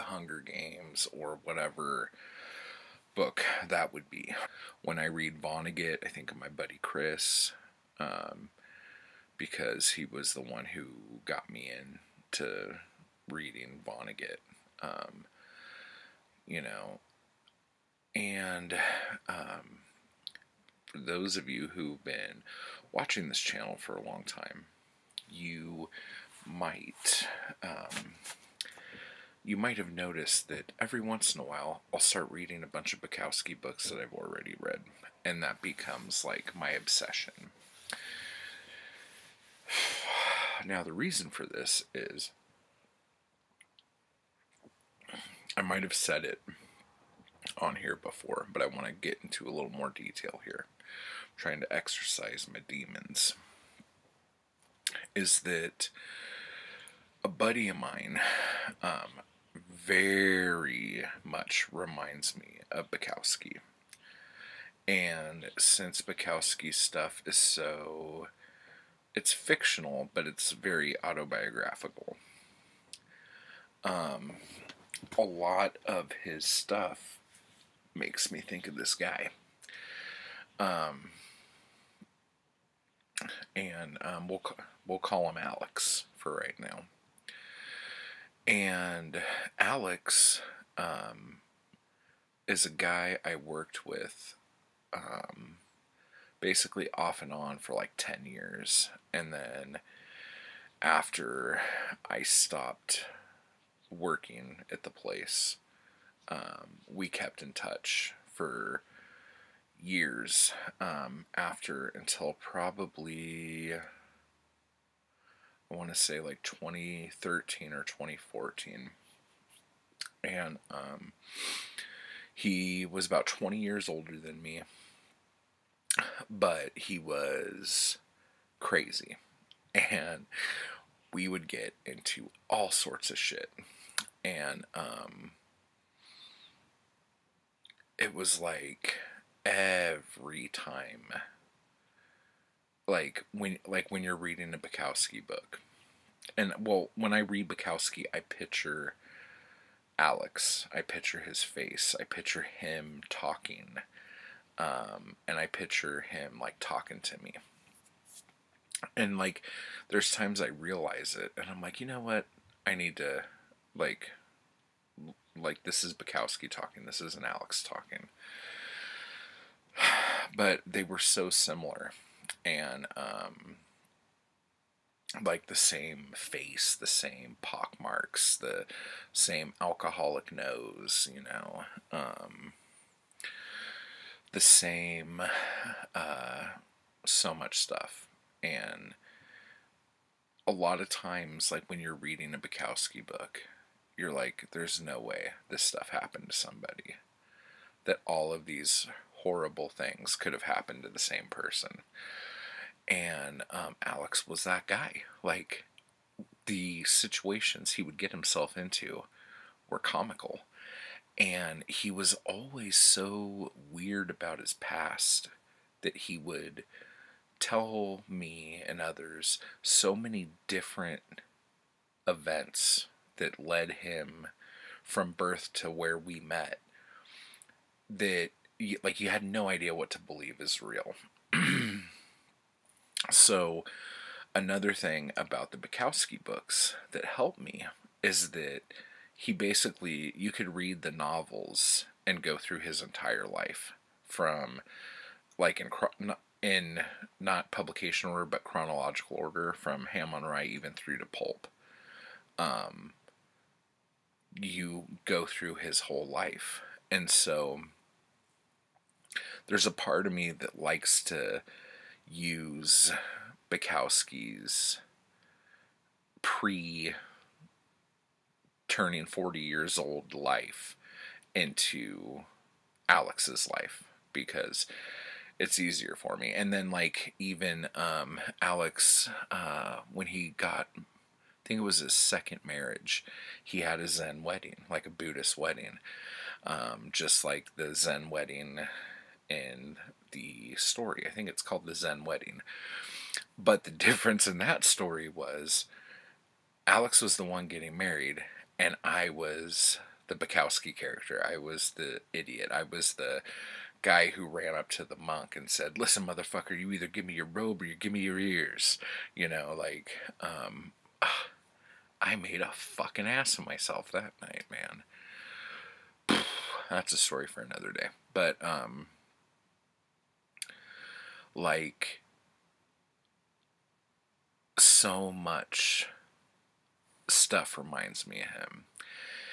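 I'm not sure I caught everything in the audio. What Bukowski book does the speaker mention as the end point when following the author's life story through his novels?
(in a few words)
Pulp.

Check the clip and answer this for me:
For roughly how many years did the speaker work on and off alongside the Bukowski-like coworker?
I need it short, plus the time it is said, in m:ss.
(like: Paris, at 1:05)
10 years, at 1:37.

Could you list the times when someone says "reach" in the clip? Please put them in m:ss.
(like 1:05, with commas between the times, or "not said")
not said.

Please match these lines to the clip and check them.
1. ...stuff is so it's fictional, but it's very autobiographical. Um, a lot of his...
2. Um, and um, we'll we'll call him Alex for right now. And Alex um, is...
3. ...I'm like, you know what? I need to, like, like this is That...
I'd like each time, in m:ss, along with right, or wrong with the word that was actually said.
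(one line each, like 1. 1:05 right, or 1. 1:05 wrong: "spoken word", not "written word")
1. 1:06 right
2. 1:20 right
3. 2:41 wrong: "Bukowski", not "That".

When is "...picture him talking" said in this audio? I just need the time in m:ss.
2:32.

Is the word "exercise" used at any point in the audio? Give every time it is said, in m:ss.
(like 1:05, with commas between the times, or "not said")
0:51.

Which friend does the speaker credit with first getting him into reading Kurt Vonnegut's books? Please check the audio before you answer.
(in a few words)
Chris.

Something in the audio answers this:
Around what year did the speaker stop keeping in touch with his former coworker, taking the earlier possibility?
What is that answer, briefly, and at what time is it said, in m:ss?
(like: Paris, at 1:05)
2013, at 1:56.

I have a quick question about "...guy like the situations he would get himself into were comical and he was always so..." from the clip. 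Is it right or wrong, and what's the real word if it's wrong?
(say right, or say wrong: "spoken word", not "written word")
right.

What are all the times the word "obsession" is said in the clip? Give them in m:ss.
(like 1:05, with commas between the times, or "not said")
0:36.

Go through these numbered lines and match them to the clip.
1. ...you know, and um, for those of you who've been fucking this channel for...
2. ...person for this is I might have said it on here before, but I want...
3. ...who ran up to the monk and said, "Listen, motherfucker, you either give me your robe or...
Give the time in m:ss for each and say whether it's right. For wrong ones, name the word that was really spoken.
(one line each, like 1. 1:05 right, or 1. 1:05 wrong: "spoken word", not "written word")
1. 0:16 wrong: "watching", not "fucking"
2. 0:40 wrong: "reason", not "person"
3. 5:04 right.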